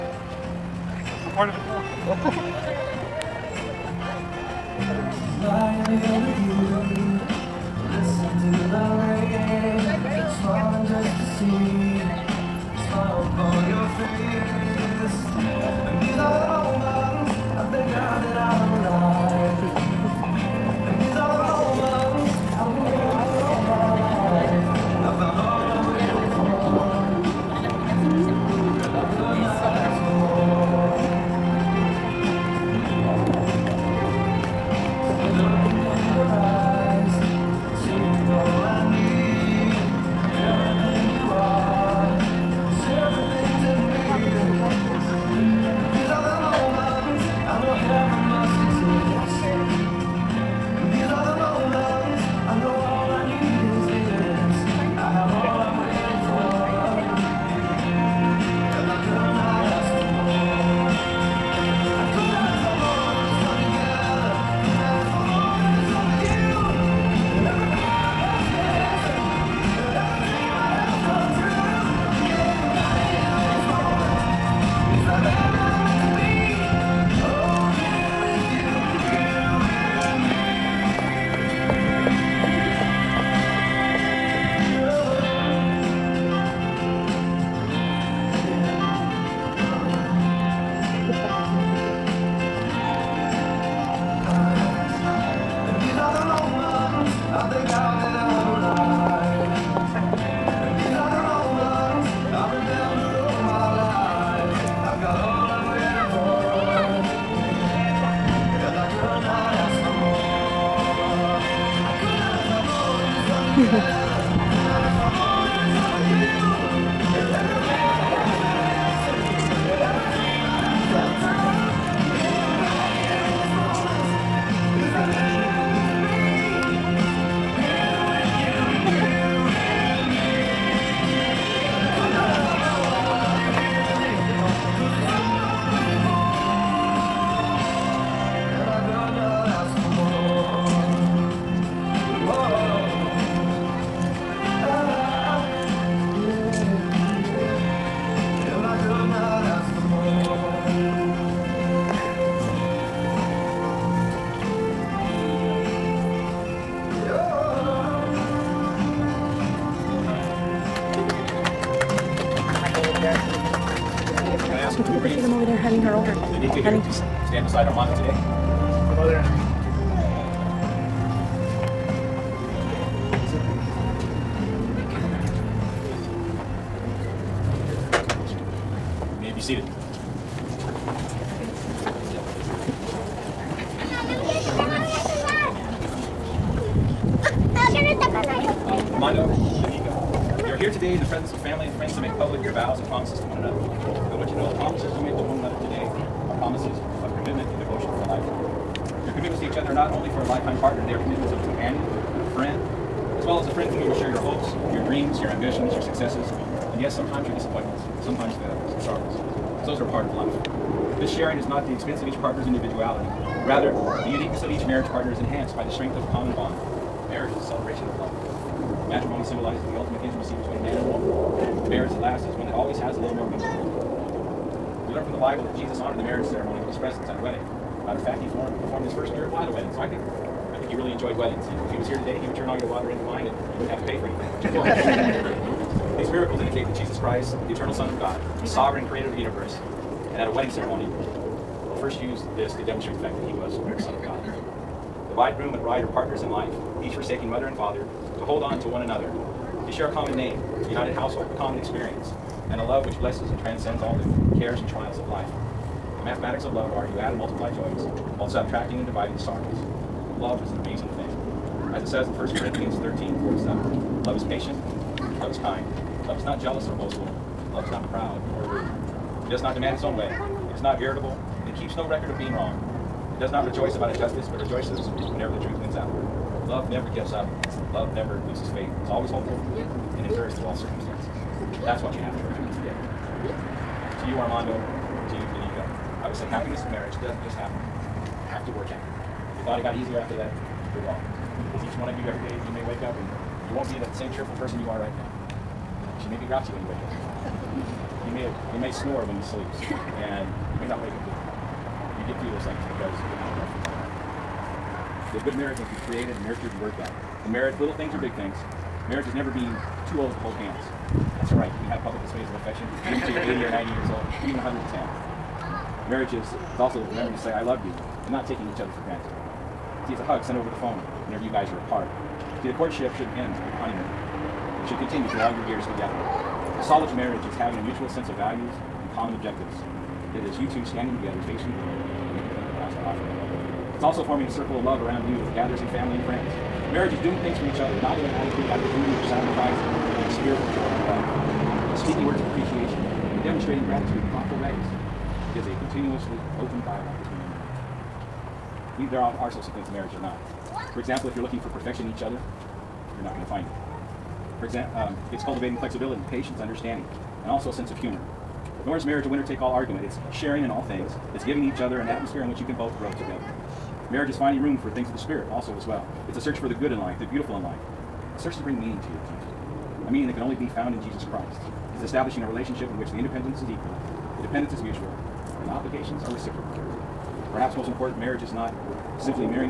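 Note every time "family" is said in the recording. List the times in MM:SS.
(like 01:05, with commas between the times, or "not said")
03:11, 05:35.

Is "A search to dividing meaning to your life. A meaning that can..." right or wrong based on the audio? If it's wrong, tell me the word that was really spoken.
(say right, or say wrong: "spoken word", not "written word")
wrong: "bring", not "dividing".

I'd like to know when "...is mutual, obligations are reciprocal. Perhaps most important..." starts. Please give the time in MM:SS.
06:14.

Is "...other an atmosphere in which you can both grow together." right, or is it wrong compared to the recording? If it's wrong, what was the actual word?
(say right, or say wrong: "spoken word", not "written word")
right.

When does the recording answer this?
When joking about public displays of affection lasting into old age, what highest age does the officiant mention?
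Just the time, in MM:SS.
05:14.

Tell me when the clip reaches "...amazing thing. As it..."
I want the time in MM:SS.
04:20.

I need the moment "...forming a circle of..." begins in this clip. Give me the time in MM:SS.
05:34.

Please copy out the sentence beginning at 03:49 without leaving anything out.
So I think he really enjoyed weddings.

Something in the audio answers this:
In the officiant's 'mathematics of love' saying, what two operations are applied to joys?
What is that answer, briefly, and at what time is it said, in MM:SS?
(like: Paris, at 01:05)
add and multiply, at 04:16.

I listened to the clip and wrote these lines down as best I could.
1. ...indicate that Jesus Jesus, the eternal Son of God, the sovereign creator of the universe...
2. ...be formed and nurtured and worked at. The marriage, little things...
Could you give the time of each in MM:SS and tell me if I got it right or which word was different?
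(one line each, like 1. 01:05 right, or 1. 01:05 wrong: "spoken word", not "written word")
1. 03:56 wrong: "Christ", not "Jesus"
2. 05:05 wrong: "created", not "formed".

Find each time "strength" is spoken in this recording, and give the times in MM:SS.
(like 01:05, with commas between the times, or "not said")
03:35.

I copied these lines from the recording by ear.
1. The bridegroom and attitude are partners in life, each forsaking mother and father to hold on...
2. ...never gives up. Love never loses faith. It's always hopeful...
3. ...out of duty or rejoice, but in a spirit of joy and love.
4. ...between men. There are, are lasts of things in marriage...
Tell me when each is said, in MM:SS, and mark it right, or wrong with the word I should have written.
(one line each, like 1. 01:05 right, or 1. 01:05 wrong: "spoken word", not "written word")
1. 04:05 wrong: "bride", not "attitude"
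2. 04:36 right
3. 05:38 wrong: "sacrifice", not "rejoice"
4. 05:47 wrong: "sorts", not "lasts".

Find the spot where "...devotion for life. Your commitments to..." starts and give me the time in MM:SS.
03:17.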